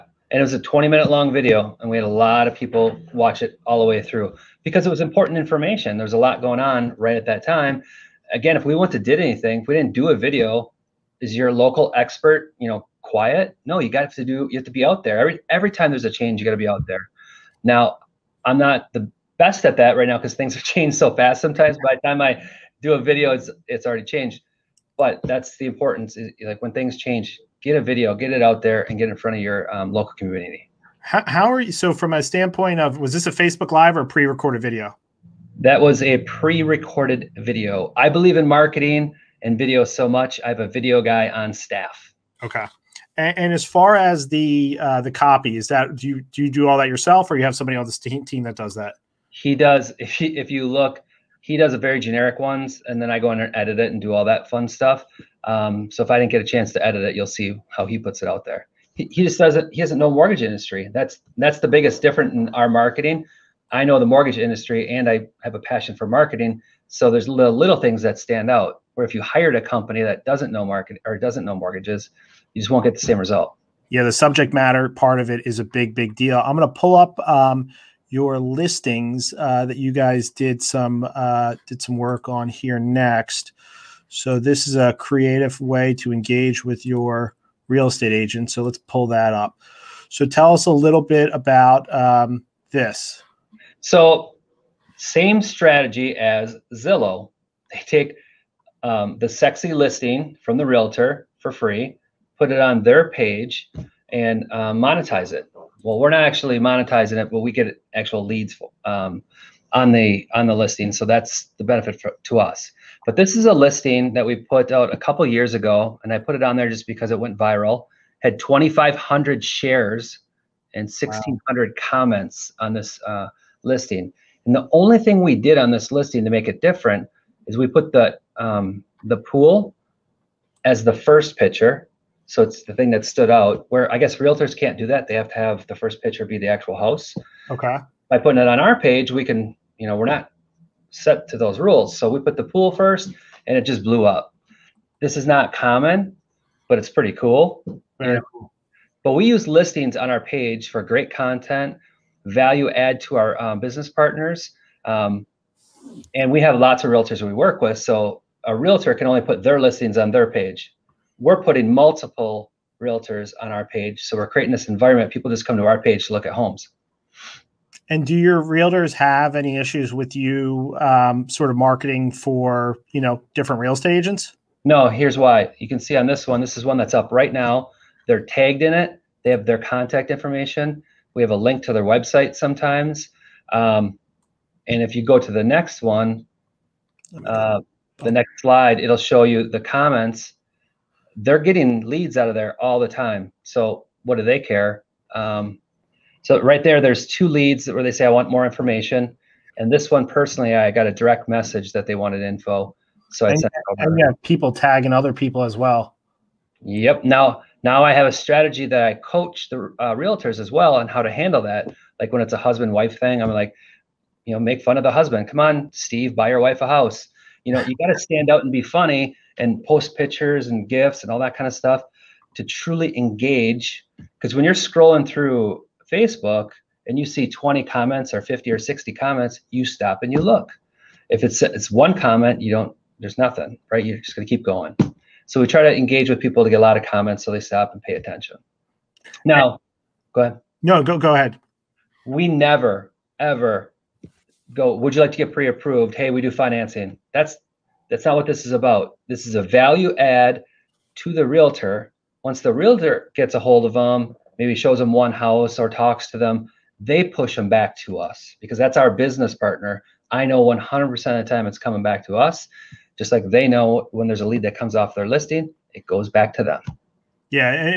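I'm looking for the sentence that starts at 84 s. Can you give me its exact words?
So this is a creative way to engage with your real estate agent.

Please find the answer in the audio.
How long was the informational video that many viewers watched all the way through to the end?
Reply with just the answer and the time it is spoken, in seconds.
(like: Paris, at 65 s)
20 minutes, at 0 s.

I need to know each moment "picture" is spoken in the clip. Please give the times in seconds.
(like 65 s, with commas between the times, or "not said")
131 s, 136 s, 219 s.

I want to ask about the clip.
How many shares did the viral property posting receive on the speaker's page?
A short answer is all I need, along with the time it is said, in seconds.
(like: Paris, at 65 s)
2,500, at 118 s.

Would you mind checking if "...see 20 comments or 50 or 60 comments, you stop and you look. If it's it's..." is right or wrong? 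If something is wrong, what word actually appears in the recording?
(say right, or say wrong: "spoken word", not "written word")
right.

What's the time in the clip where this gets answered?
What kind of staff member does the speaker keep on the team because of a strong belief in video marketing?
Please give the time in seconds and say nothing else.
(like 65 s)
40 s.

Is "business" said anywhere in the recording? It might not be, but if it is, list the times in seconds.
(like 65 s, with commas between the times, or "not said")
153 s, 258 s.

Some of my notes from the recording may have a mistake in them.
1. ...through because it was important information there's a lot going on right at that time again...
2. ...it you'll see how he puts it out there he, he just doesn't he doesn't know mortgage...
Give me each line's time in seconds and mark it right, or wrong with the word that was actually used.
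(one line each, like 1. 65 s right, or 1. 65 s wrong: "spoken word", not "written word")
1. 4 s right
2. 57 s right.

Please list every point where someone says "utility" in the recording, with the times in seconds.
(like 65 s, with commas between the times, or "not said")
not said.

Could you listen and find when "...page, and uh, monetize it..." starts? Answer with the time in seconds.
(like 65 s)
103 s.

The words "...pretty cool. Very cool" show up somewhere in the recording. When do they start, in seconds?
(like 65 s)
146 s.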